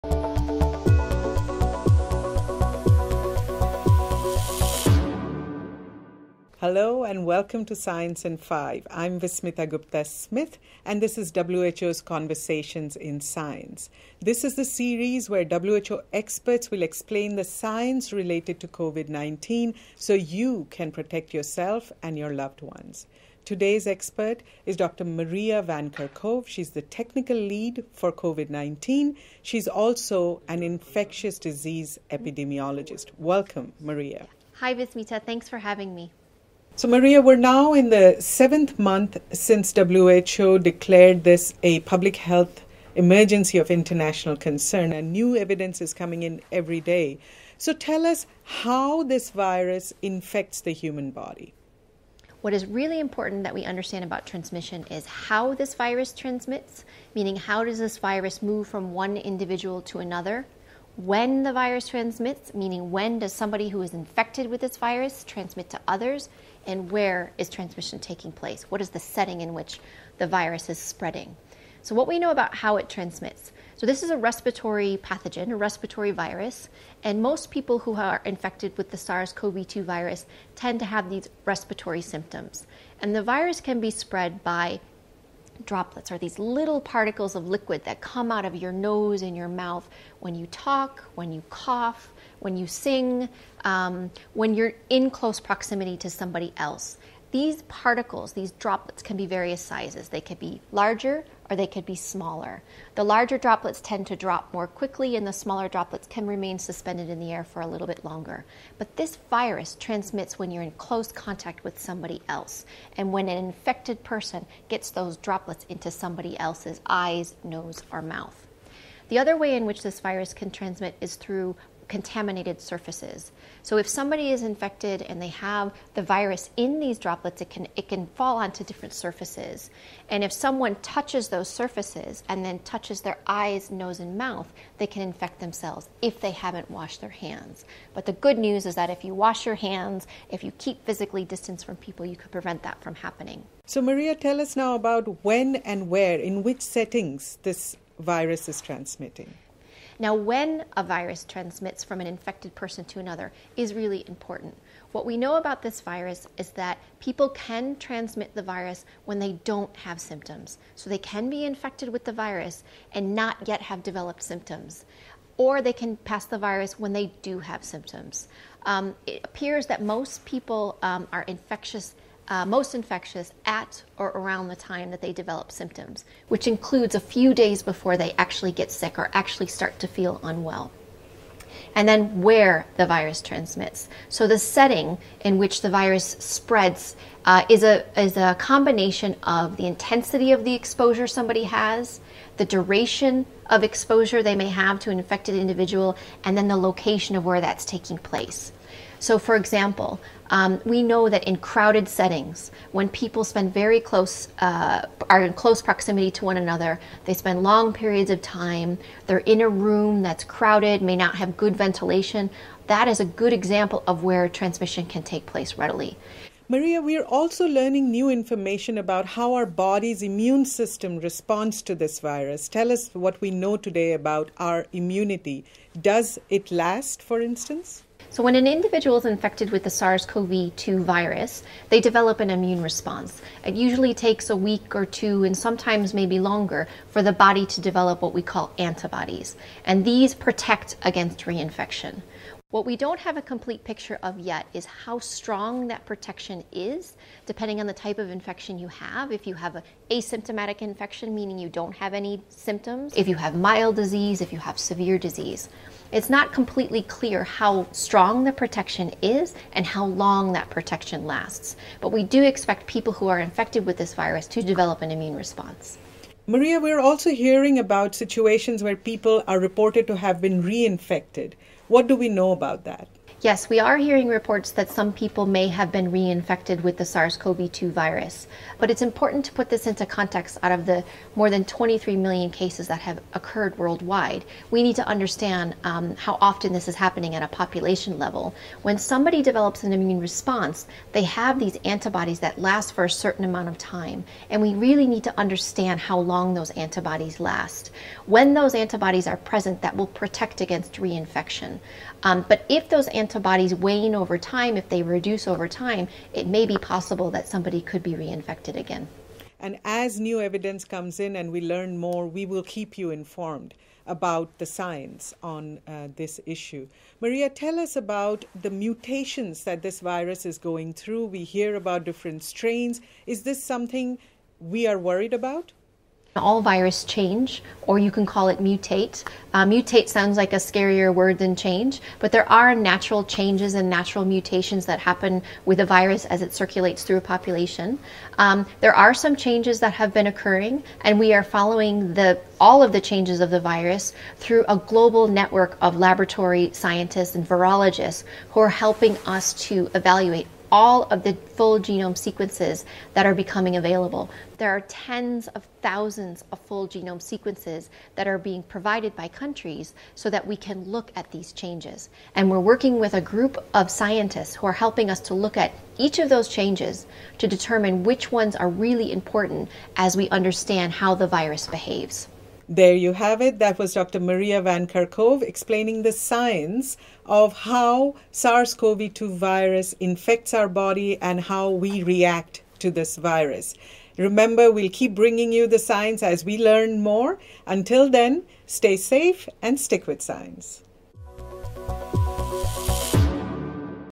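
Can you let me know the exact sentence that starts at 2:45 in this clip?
Or they can pass the virus when they do have symptoms.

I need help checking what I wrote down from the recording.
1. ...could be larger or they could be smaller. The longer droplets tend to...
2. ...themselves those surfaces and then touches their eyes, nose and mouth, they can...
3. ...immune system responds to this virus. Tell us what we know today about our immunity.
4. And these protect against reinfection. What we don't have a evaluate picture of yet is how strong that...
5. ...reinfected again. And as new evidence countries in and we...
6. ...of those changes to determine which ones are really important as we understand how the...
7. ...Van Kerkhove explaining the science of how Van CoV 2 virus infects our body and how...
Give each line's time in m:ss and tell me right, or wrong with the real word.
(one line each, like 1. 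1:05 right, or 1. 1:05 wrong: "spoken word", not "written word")
1. 1:40 wrong: "larger", not "longer"
2. 2:10 wrong: "touches", not "themselves"
3. 3:40 right
4. 3:59 wrong: "complete", not "evaluate"
5. 5:07 wrong: "comes", not "countries"
6. 6:05 right
7. 6:14 wrong: "SARS", not "Van".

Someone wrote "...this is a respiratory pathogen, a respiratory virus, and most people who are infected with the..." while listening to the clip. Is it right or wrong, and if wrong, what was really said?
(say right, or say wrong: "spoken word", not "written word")
right.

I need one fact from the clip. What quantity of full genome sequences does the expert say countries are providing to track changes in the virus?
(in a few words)
tens of thousands.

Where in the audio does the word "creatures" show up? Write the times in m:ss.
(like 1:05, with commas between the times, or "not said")
not said.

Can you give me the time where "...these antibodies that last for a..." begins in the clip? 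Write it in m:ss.
4:51.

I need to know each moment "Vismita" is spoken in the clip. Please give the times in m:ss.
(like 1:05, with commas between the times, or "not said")
0:09, 0:34.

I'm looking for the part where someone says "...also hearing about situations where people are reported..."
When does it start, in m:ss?
4:26.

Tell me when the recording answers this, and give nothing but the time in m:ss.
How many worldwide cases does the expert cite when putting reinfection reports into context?
4:41.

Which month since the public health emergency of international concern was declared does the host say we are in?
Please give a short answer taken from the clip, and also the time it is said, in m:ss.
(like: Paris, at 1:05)
seventh, at 0:38.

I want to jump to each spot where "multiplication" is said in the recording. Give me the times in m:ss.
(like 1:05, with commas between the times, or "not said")
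not said.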